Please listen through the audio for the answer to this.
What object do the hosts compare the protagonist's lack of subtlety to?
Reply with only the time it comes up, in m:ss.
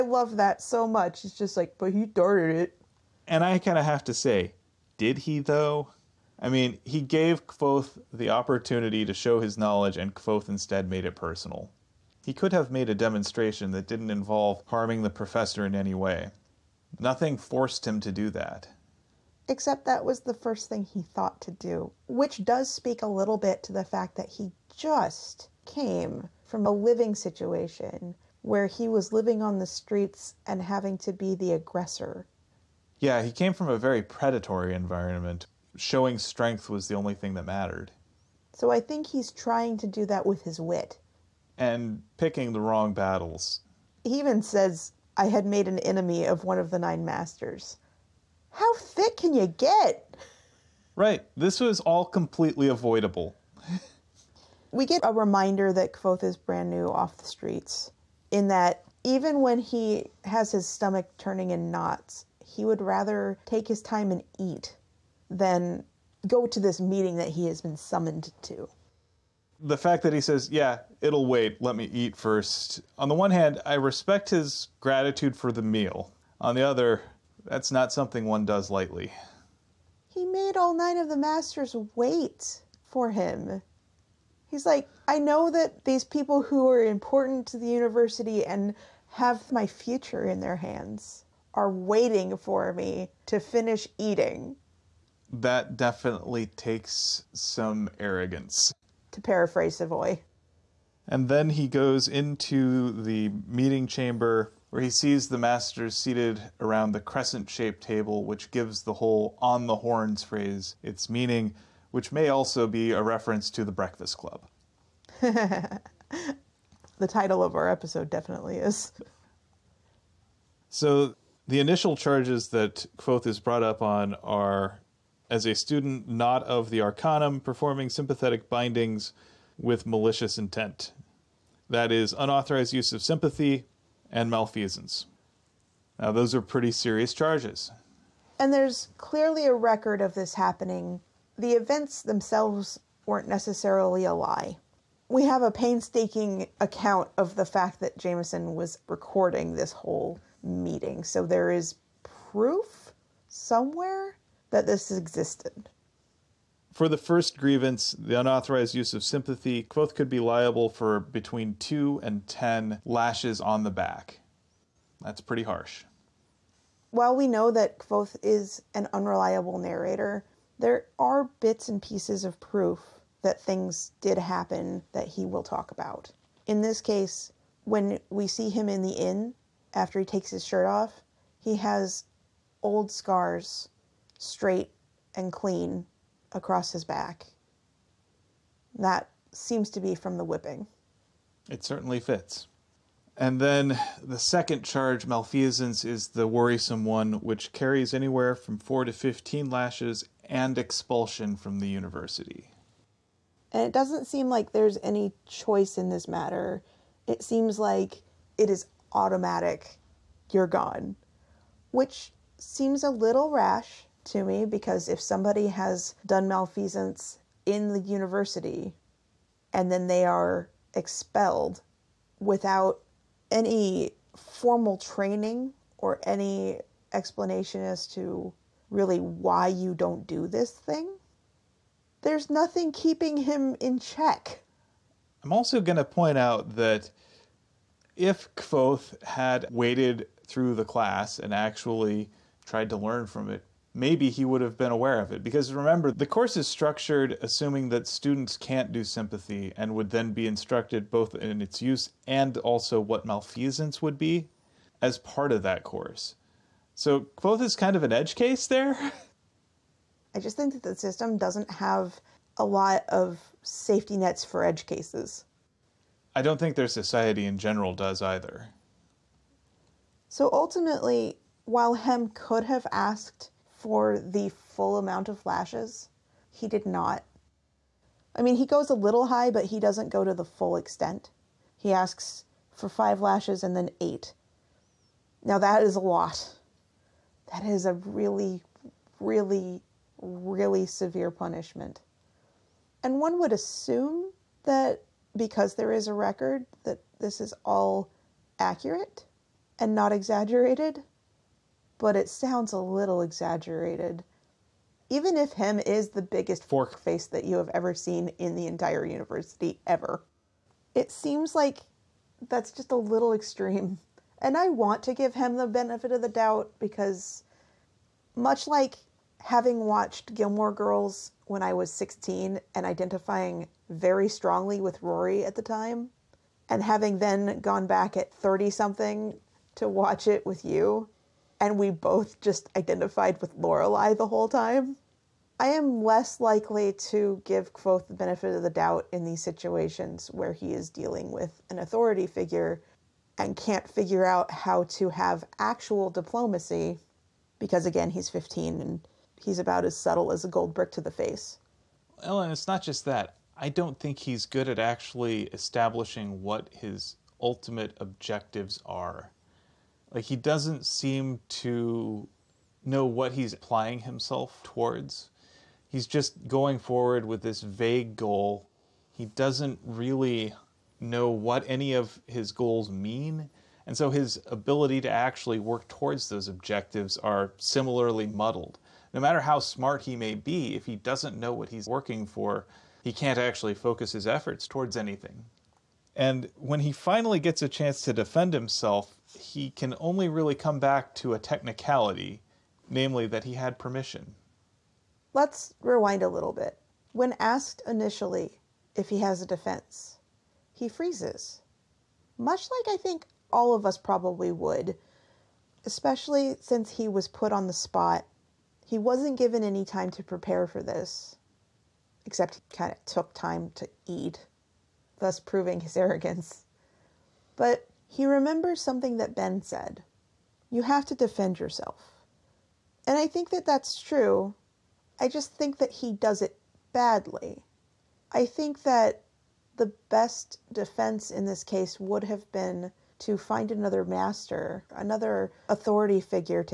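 5:50.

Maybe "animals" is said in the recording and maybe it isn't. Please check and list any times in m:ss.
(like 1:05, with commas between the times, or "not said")
not said.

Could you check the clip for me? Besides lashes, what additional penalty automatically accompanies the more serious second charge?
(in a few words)
Expulsion from the university.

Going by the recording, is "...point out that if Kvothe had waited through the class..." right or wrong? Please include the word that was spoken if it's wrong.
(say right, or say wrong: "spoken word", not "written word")
right.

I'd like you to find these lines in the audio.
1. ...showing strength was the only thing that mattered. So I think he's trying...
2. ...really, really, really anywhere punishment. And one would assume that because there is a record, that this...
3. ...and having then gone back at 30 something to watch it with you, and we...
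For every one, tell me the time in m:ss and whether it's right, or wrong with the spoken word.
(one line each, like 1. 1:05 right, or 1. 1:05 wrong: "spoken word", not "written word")
1. 0:35 right
2. 4:47 wrong: "severe", not "anywhere"
3. 5:26 right.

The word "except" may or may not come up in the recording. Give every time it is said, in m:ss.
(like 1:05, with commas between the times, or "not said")
0:19, 6:52.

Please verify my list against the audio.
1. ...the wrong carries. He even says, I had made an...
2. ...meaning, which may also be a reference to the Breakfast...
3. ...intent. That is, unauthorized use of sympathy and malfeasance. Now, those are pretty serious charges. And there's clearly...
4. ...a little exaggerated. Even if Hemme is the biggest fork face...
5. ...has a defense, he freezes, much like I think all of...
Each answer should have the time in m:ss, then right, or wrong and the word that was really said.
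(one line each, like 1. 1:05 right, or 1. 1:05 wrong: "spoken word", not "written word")
1. 0:42 wrong: "battles", not "carries"
2. 1:51 right
3. 2:10 right
4. 5:02 right
5. 6:38 right.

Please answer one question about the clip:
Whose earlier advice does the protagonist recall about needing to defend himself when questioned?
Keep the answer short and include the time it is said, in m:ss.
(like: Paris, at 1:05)
Ben, at 6:59.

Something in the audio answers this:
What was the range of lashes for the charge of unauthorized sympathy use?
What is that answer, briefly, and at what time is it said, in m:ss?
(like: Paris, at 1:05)
2 to 10, at 2:41.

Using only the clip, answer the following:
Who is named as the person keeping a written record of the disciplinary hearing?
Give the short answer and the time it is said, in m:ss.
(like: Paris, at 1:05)
Jamison, at 2:27.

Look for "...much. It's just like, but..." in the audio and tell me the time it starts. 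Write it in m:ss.
0:00.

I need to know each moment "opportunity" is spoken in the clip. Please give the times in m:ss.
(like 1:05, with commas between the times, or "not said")
0:08.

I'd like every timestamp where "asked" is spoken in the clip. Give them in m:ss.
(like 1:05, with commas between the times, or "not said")
4:32, 6:37.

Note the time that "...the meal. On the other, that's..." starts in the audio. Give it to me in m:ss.
1:15.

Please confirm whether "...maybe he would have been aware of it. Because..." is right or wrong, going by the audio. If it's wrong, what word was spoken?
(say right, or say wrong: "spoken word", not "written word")
right.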